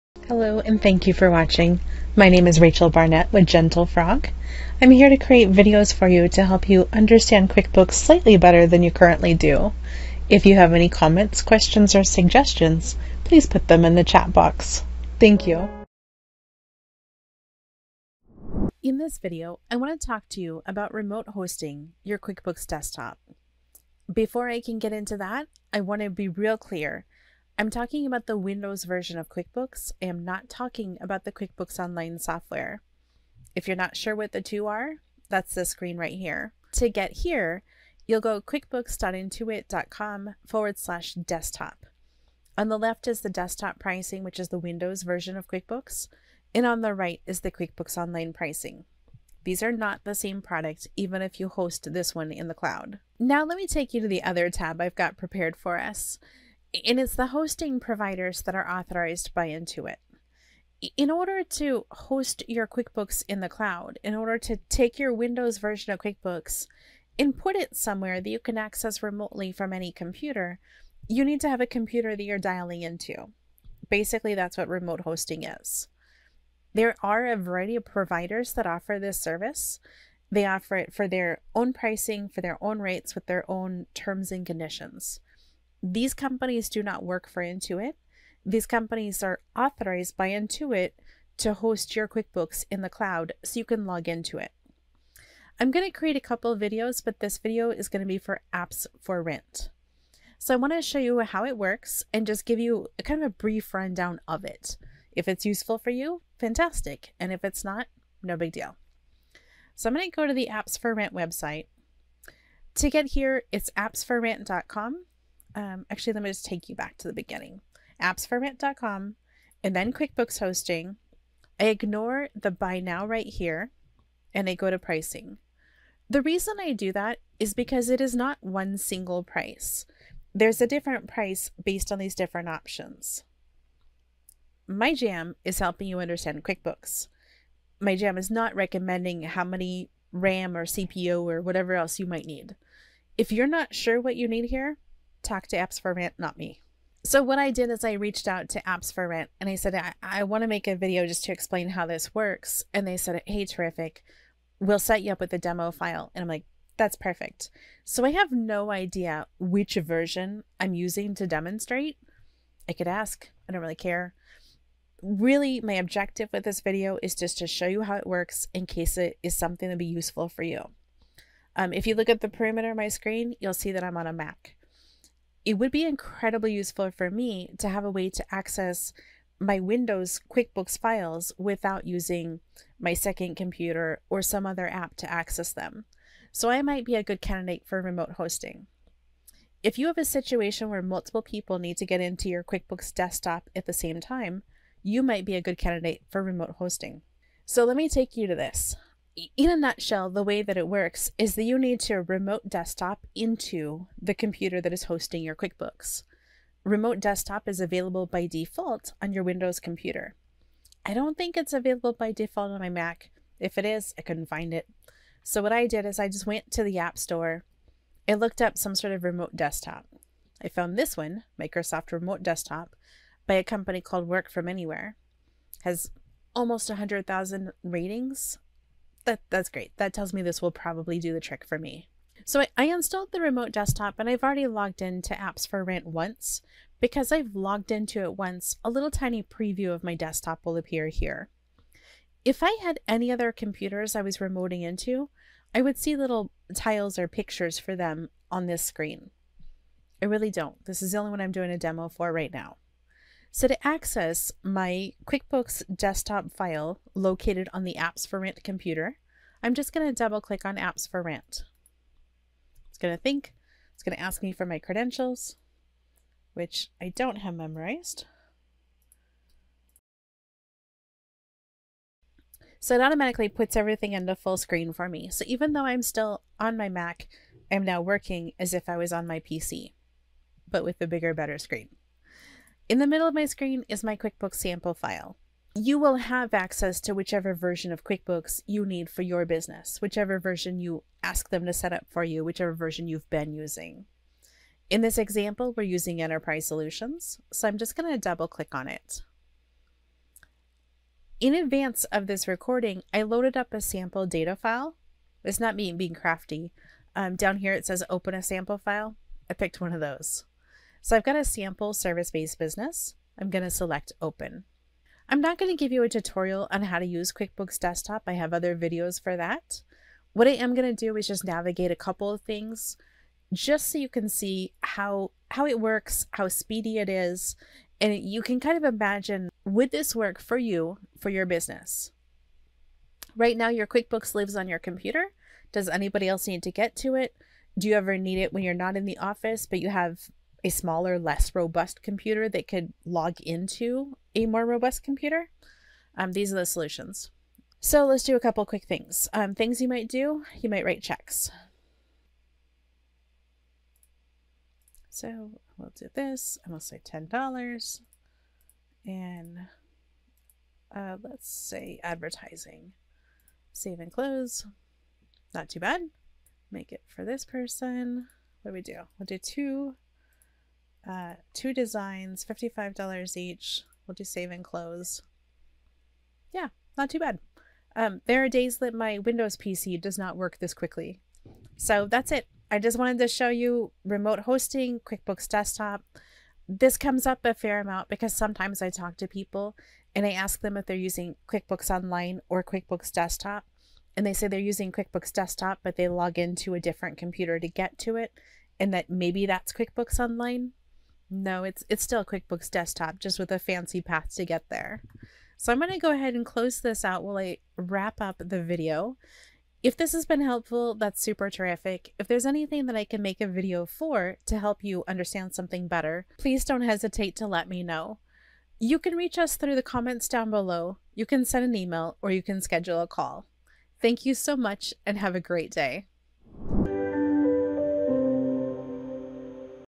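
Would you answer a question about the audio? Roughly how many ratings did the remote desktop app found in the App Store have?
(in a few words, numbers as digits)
almost 100,000.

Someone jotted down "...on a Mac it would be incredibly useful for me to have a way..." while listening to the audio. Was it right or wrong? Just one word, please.
right.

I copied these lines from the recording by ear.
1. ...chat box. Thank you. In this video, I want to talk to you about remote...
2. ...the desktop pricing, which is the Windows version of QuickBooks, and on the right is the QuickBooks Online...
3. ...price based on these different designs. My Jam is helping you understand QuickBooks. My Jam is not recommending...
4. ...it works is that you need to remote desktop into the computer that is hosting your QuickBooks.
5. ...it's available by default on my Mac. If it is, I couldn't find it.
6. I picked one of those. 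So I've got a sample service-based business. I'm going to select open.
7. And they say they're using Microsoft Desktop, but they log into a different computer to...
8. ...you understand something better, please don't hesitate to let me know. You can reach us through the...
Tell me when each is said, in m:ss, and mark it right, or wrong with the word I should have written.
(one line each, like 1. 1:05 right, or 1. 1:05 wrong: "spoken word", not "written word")
1. 0:14 right
2. 0:43 right
3. 2:11 wrong: "options", not "designs"
4. 3:20 right
5. 3:31 right
6. 5:09 right
7. 6:33 wrong: "QuickBooks", not "Microsoft"
8. 6:54 right.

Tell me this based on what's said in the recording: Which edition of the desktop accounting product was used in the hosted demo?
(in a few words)
Enterprise Solutions.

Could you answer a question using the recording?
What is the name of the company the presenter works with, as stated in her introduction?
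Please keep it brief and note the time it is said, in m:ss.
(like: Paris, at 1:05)
Gentle Frog, at 0:03.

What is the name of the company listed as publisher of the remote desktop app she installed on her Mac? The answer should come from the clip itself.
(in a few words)
Work From Anywhere.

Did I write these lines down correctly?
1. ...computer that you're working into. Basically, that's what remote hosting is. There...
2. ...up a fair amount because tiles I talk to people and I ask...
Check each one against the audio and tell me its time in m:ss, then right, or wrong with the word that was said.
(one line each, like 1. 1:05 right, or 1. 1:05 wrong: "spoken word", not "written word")
1. 1:11 wrong: "dialing", not "working"
2. 6:27 wrong: "sometimes", not "tiles".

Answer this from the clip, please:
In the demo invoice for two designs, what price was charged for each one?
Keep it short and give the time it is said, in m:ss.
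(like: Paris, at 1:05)
$55, at 6:12.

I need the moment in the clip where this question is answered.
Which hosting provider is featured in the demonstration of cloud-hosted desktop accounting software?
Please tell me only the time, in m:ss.
1:38.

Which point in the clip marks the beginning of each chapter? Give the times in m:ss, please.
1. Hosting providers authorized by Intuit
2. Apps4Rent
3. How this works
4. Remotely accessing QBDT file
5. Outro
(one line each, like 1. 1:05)
1. 0:50
2. 1:48
3. 3:18
4. 5:05
5. 6:49.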